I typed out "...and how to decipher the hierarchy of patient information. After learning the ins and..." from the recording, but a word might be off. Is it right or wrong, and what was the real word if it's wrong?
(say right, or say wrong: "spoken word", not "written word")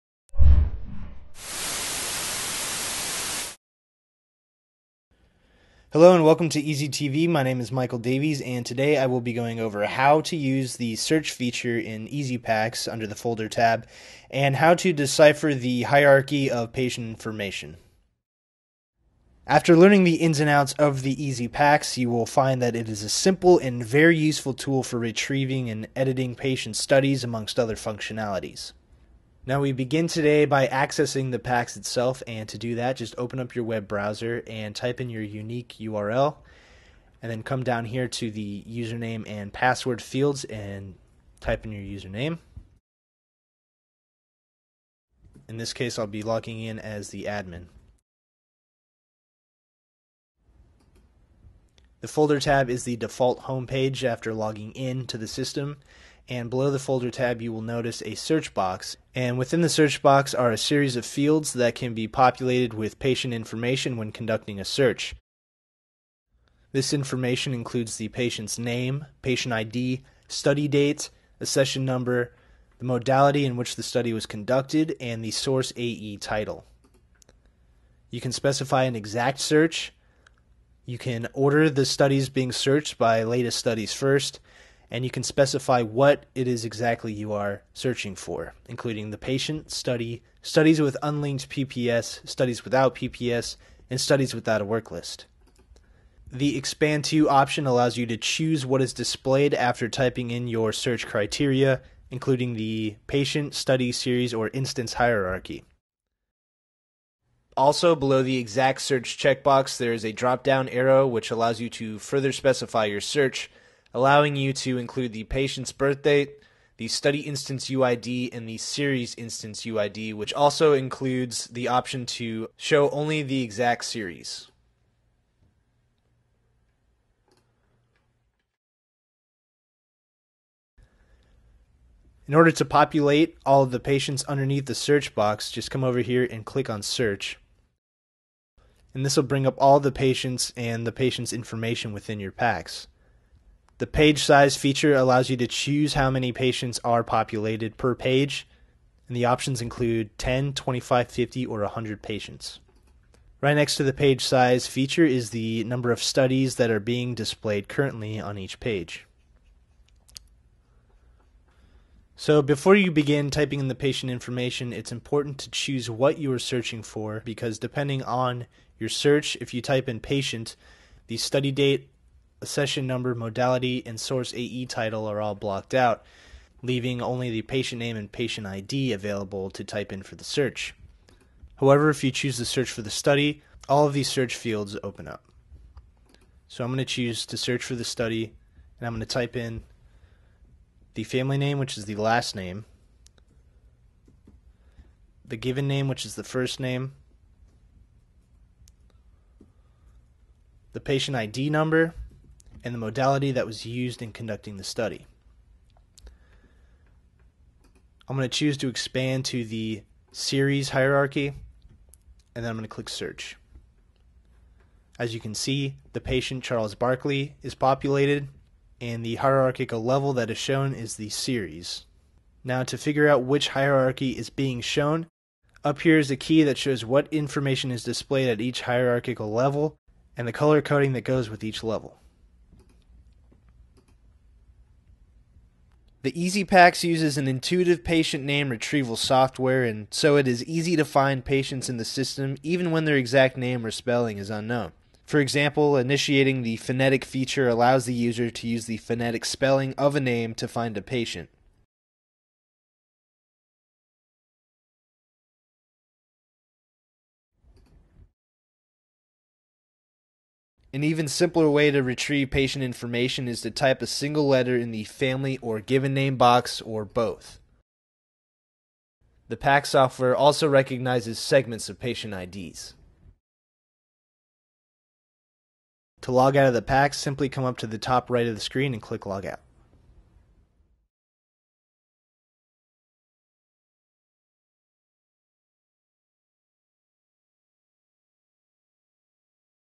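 right.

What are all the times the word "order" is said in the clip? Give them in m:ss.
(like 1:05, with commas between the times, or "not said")
1:21, 2:12.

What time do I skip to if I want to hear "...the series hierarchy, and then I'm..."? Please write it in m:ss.
3:29.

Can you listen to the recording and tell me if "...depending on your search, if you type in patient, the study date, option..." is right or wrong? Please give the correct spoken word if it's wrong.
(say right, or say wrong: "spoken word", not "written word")
wrong: "session", not "option".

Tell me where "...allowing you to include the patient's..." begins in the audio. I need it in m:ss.
1:53.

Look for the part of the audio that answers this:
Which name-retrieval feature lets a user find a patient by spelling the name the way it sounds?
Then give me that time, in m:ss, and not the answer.
4:06.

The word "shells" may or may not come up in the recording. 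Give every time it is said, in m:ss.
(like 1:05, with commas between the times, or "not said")
not said.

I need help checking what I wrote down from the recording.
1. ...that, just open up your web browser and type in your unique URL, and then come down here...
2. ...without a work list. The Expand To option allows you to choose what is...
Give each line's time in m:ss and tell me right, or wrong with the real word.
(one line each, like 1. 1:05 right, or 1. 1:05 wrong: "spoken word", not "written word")
1. 0:32 right
2. 1:34 right.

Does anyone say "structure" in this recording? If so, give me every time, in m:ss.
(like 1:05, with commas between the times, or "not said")
not said.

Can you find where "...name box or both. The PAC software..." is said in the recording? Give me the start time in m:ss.
4:25.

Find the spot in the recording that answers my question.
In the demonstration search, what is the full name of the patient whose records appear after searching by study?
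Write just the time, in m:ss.
3:36.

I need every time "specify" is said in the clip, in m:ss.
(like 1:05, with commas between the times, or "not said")
1:18, 1:25, 1:52.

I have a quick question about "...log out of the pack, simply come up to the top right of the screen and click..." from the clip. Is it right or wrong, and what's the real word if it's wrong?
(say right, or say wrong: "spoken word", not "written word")
right.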